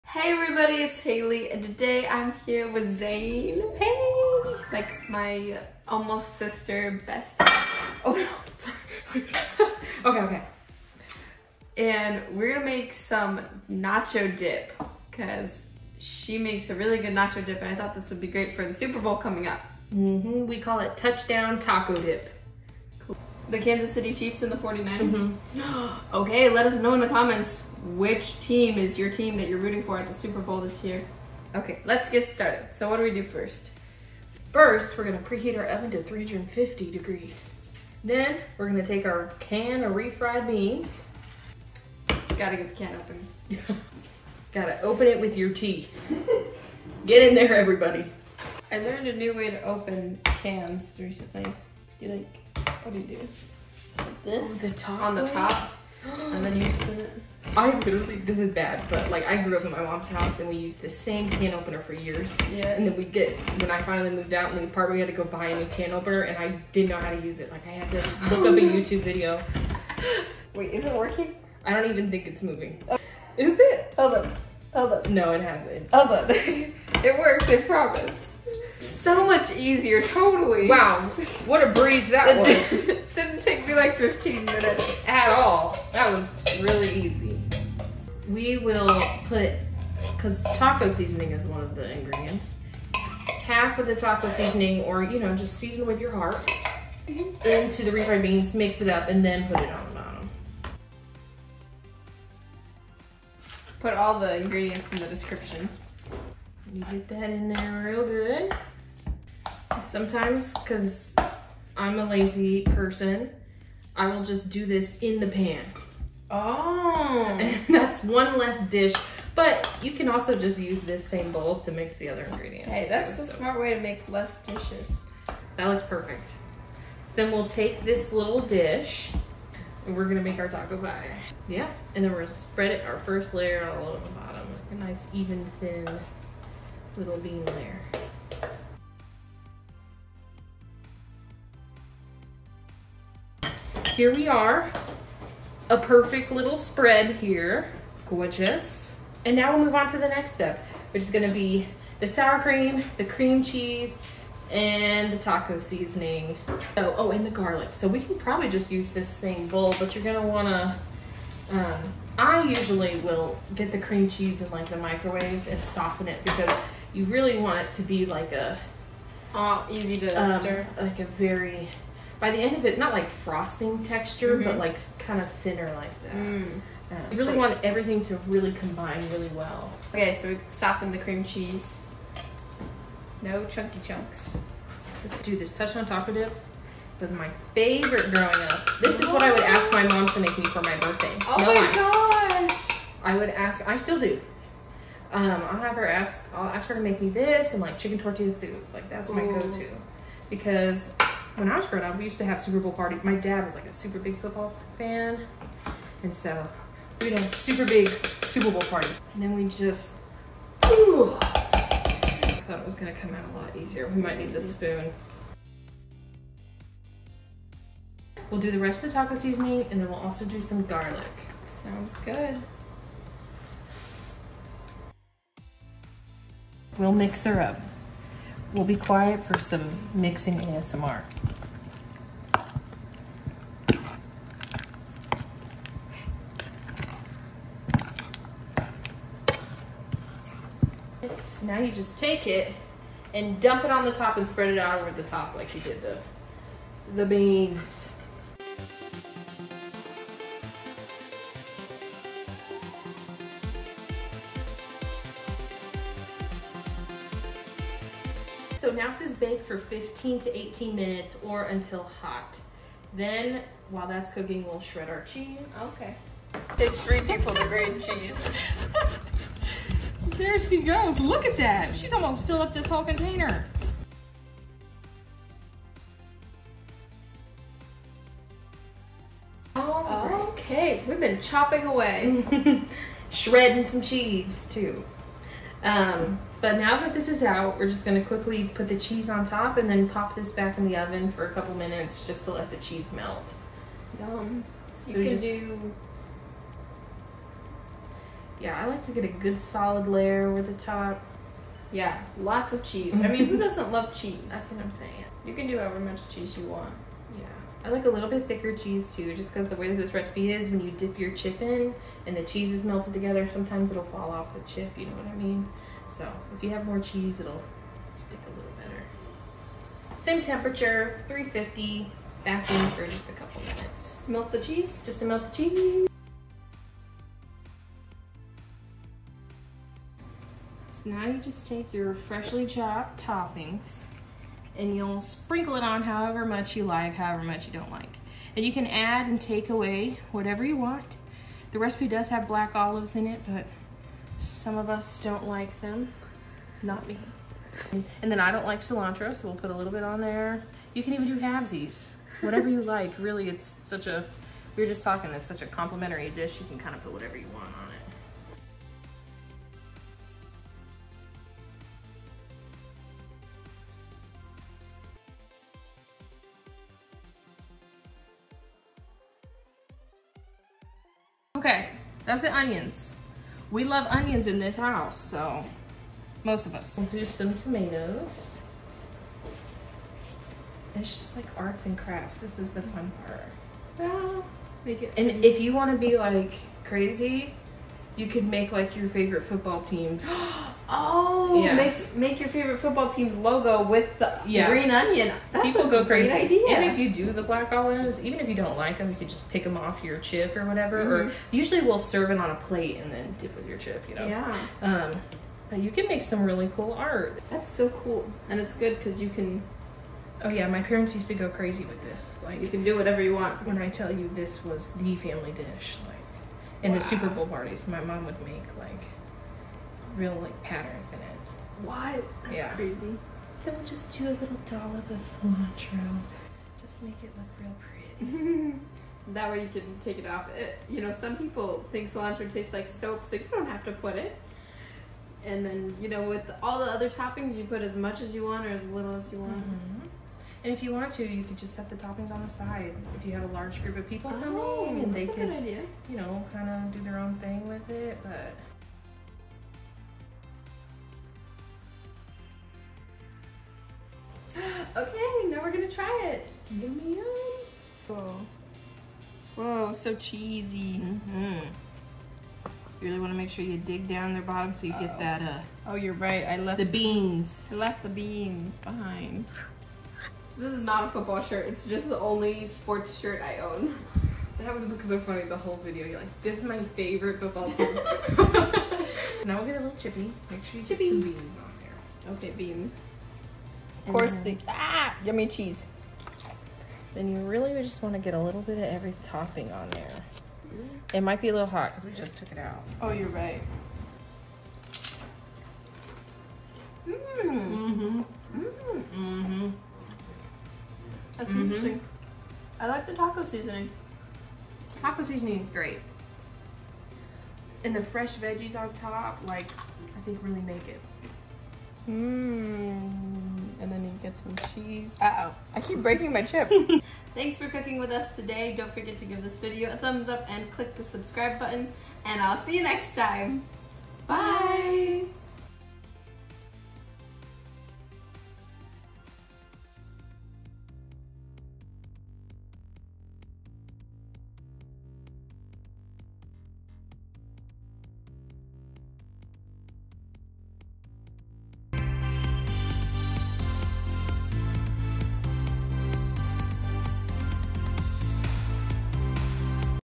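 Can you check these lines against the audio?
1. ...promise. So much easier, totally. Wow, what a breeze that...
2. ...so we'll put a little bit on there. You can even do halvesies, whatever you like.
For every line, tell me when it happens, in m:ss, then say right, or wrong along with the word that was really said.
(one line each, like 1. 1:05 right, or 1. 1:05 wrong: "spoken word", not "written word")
1. 1:17 right
2. 5:49 right.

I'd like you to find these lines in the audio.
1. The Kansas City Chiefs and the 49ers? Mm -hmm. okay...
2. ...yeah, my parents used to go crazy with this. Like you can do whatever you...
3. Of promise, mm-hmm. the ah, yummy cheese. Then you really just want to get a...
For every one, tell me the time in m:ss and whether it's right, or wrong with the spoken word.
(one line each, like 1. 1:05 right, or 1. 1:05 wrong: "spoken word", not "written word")
1. 0:23 right
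2. 6:50 right
3. 8:03 wrong: "course", not "promise".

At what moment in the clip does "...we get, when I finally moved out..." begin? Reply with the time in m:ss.
1:02.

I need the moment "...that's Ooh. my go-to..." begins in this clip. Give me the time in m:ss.
3:18.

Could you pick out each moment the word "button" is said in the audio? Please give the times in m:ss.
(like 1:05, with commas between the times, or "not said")
8:41.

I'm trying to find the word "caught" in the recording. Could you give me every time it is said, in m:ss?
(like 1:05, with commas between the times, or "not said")
not said.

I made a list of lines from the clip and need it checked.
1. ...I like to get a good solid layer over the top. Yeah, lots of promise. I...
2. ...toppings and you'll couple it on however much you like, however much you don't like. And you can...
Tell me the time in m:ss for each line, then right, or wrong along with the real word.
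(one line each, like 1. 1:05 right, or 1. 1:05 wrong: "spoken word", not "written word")
1. 4:58 wrong: "cheese", not "promise"
2. 5:33 wrong: "sprinkle", not "couple".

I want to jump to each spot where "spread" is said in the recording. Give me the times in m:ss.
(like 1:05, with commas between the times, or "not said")
2:12, 2:26, 4:04.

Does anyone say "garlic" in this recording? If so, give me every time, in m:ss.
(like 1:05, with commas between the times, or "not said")
2:37, 3:40.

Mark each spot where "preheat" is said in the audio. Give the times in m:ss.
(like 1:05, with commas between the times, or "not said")
0:35.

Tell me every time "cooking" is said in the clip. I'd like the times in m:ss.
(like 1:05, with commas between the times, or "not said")
4:24, 8:37.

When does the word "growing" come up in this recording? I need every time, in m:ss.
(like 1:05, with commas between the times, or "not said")
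3:08, 3:21.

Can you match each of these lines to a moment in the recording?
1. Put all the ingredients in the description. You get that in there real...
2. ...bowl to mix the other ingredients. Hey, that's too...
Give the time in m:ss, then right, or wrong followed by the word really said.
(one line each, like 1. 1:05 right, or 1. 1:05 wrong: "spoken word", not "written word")
1. 1:43 right
2. 2:01 right.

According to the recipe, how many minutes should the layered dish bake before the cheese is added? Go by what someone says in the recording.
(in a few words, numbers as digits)
15 to 18 minutes.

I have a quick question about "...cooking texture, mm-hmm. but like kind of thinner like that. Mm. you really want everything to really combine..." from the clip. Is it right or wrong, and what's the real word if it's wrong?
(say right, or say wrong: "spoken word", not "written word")
wrong: "frosting", not "cooking".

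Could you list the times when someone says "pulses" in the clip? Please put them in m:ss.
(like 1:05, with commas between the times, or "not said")
not said.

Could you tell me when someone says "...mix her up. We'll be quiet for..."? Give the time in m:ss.
3:46.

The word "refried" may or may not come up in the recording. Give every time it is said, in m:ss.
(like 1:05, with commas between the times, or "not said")
0:39, 1:37.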